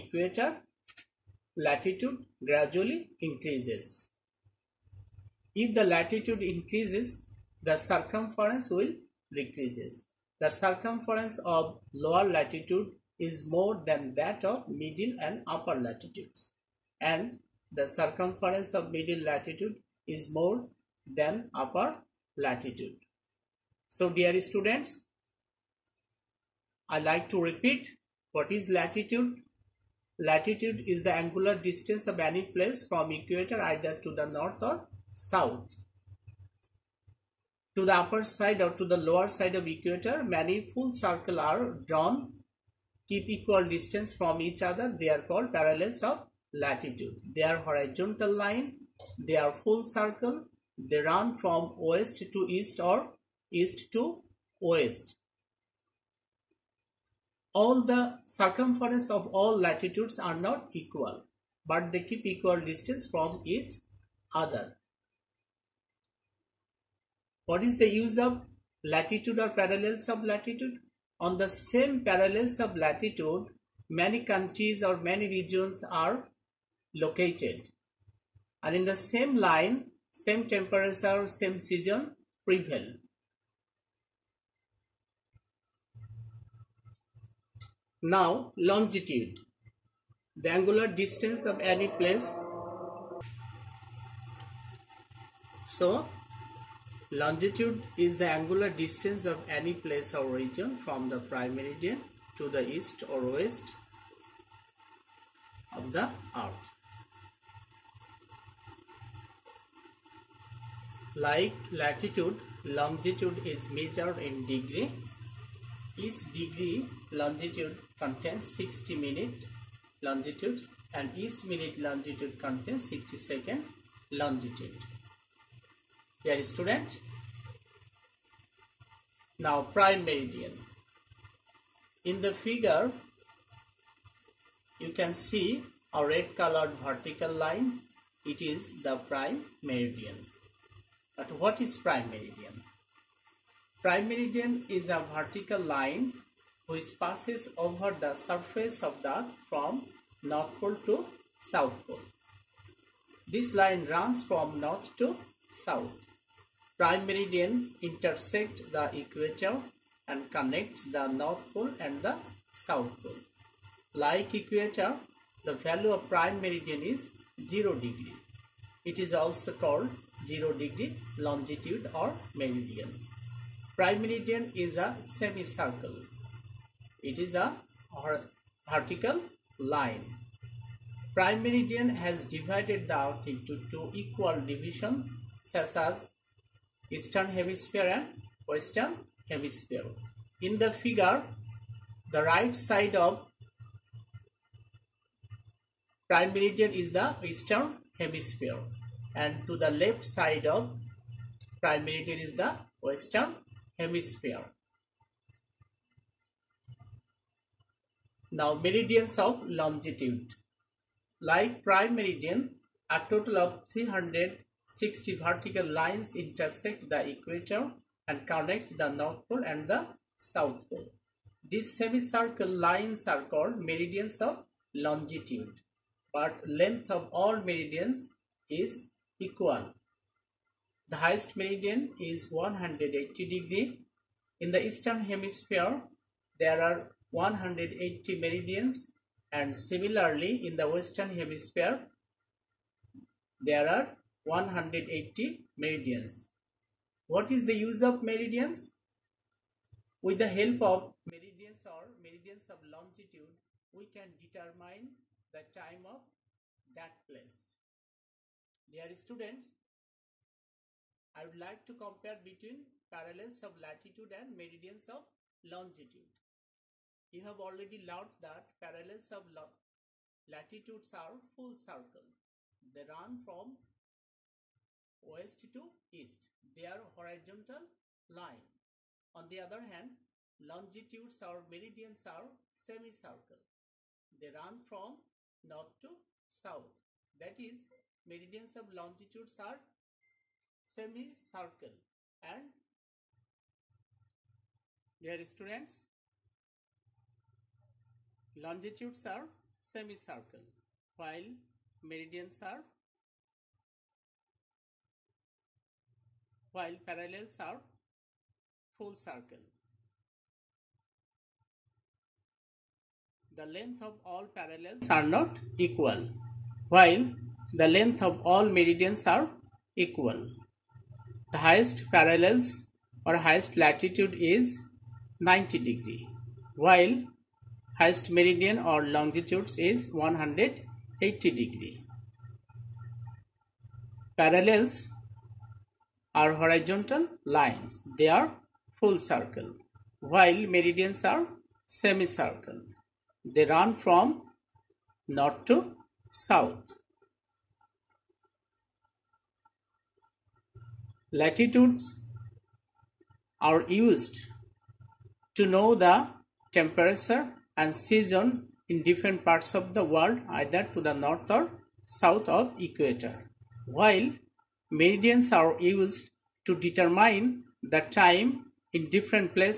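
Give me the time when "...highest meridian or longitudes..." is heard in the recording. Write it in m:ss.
5:27.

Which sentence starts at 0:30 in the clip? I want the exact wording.
Latitude is the angular distance of any place from equator either to the north or south.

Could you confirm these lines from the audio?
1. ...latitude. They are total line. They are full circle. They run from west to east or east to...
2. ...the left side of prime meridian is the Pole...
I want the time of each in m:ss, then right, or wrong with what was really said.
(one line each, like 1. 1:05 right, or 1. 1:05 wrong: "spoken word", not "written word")
1. 0:46 wrong: "horizontal", not "total"
2. 3:19 wrong: "Western", not "Pole".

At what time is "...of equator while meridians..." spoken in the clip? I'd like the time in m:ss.
6:02.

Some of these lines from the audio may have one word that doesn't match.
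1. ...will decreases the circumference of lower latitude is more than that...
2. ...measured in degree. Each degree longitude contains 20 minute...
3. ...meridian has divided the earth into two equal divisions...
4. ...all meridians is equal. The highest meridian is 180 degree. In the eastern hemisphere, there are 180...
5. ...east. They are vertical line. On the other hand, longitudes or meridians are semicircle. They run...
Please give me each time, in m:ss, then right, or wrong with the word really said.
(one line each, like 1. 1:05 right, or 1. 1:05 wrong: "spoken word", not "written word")
1. 0:08 right
2. 1:53 wrong: "60", not "20"
3. 3:01 right
4. 3:47 right
5. 4:35 wrong: "horizontal", not "vertical".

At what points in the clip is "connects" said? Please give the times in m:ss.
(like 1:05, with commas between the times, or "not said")
2:40, 3:38.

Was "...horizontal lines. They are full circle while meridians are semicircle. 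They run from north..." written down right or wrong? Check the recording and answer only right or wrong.
right.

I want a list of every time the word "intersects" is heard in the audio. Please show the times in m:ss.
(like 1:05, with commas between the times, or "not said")
2:37, 3:36.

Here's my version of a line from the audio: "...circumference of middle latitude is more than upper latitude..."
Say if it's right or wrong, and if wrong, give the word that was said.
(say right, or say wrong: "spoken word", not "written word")
right.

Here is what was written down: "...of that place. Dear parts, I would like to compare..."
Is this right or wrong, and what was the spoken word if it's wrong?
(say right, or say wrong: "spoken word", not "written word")
wrong: "students", not "parts".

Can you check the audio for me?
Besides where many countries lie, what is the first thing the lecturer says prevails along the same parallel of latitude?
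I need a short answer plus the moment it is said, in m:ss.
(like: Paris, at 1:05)
same temperature, at 1:20.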